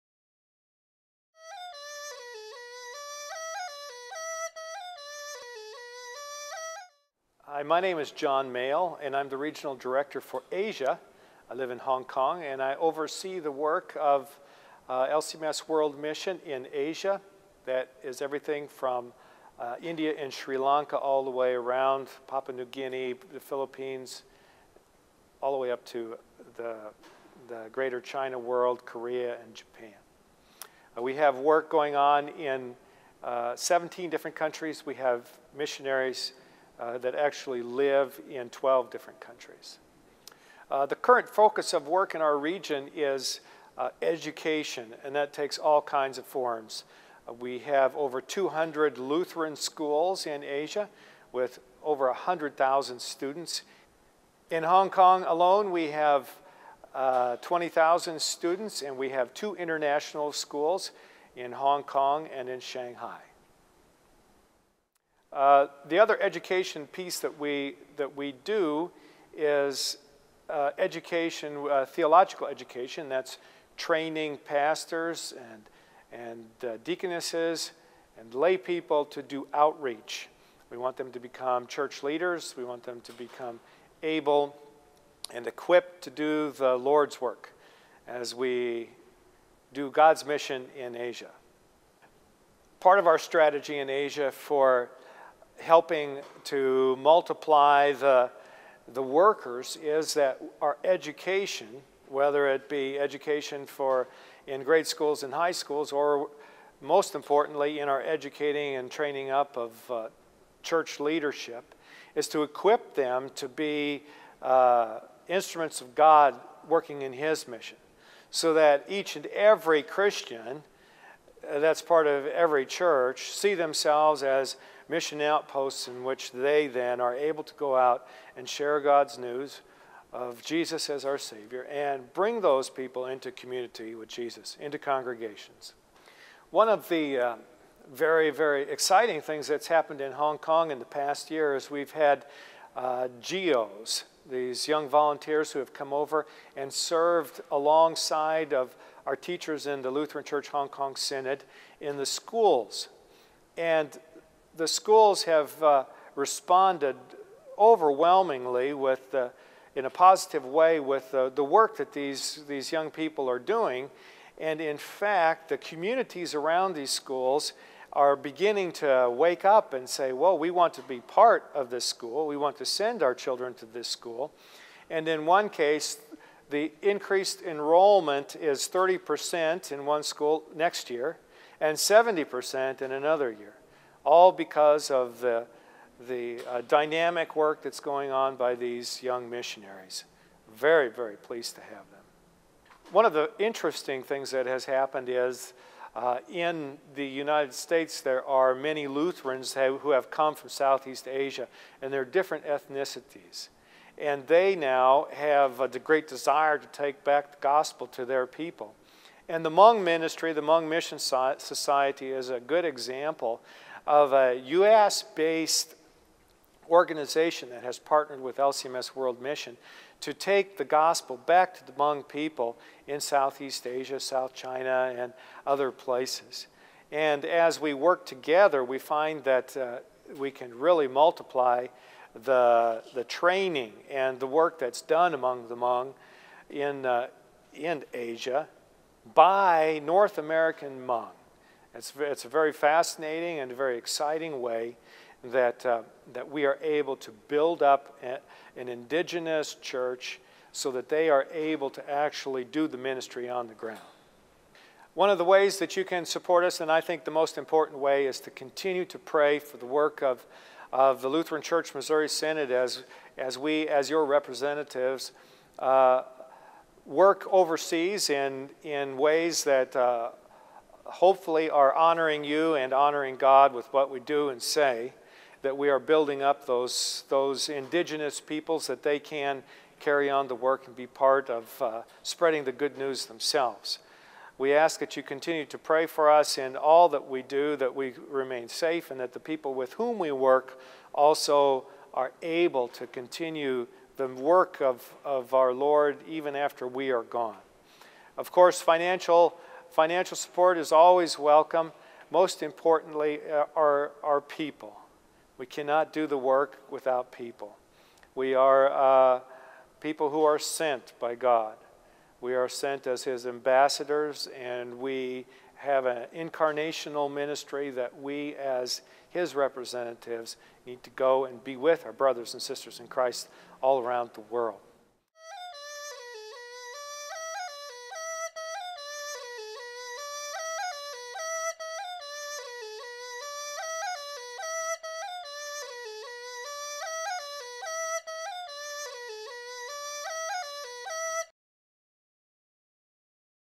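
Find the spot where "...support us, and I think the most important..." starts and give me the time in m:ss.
4:16.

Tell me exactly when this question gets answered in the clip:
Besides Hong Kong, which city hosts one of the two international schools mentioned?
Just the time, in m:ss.
1:02.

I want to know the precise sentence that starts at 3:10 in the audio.
Very, very pleased to have them.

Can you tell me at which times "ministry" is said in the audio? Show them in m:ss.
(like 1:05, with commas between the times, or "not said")
3:29, 4:12, 5:17.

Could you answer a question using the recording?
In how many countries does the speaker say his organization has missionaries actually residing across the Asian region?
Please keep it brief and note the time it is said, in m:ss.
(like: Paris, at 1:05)
12, at 0:38.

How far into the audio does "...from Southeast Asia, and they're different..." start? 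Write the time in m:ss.
3:20.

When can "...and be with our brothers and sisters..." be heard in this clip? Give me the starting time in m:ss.
5:21.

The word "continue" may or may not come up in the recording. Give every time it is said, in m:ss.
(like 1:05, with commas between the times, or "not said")
4:18, 4:45, 4:52.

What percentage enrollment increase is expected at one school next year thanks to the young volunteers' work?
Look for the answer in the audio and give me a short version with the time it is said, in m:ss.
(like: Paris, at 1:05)
30%, at 2:58.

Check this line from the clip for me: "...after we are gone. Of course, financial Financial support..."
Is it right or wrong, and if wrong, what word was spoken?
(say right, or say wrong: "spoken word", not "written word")
right.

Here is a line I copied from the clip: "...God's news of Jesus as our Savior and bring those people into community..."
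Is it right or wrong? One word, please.
right.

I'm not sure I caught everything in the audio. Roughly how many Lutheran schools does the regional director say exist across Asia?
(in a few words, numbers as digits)
over 200.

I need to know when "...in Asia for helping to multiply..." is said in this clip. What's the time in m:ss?
1:33.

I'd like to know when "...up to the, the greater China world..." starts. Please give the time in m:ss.
0:25.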